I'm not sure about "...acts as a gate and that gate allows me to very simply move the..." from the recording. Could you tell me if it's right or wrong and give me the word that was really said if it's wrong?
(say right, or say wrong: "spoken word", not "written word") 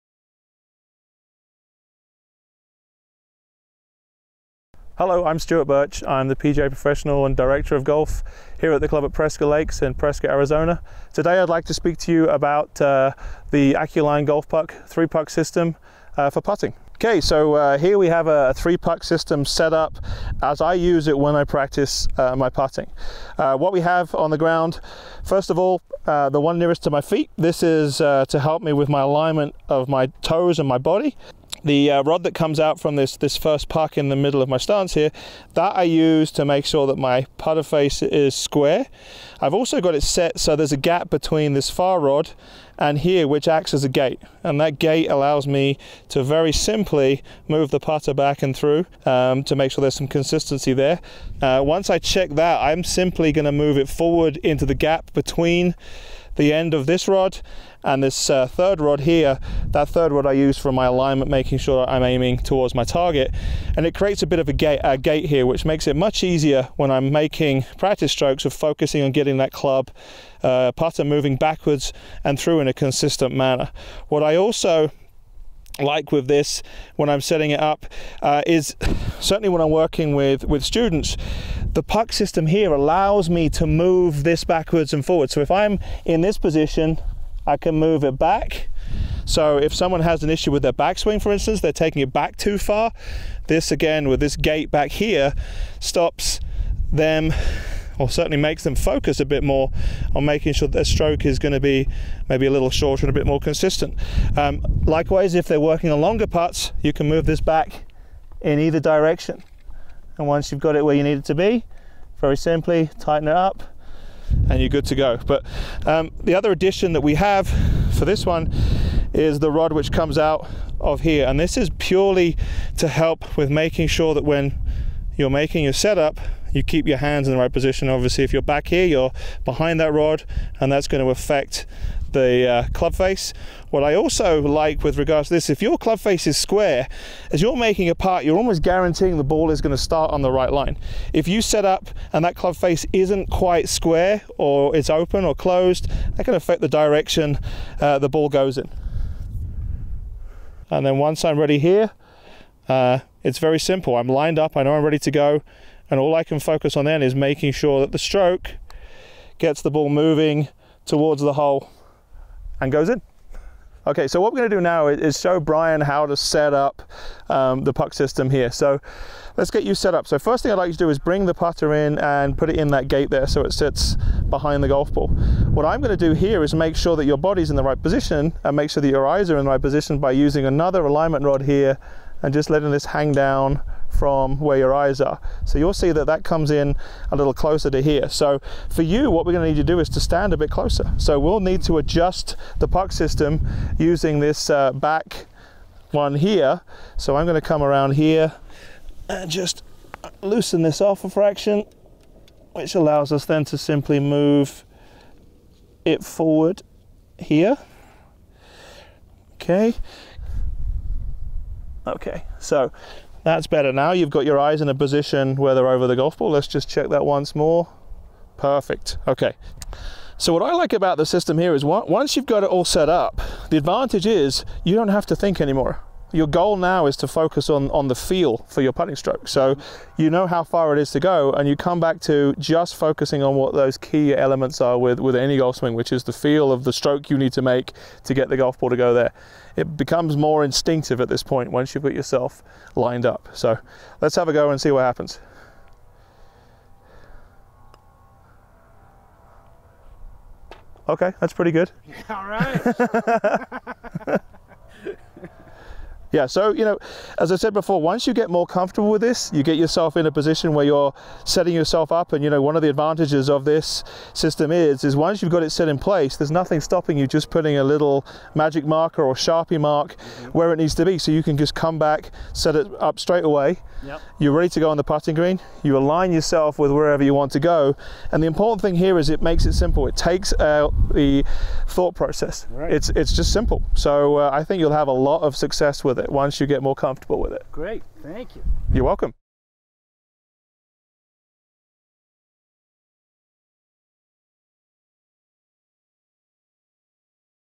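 right.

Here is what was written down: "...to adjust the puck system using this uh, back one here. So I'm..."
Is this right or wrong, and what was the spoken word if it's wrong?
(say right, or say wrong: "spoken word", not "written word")
right.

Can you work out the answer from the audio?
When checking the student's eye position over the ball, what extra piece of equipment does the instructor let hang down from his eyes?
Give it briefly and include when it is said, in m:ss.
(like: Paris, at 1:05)
alignment rod, at 3:00.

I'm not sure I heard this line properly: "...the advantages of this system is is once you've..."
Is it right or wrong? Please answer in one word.
right.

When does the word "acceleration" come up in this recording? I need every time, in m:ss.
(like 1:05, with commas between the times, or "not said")
not said.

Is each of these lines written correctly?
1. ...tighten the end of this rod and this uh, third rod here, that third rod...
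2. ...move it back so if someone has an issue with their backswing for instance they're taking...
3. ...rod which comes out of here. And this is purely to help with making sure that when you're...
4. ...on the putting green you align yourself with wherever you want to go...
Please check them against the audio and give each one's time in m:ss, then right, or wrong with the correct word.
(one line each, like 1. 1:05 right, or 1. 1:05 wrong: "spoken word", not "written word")
1. 0:55 wrong: "between", not "tighten"
2. 1:27 right
3. 1:59 right
4. 4:34 right.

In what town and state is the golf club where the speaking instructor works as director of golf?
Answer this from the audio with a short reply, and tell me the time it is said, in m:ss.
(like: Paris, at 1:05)
Prescott, Arizona, at 0:09.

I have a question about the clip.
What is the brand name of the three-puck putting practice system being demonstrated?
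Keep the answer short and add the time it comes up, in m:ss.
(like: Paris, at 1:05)
Acculine Golf Puck, at 0:13.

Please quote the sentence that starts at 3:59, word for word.
It becomes more instinctive at this point once you've got yourself lined up.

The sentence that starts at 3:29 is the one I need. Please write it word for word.
Okay, Okay, so that's better now.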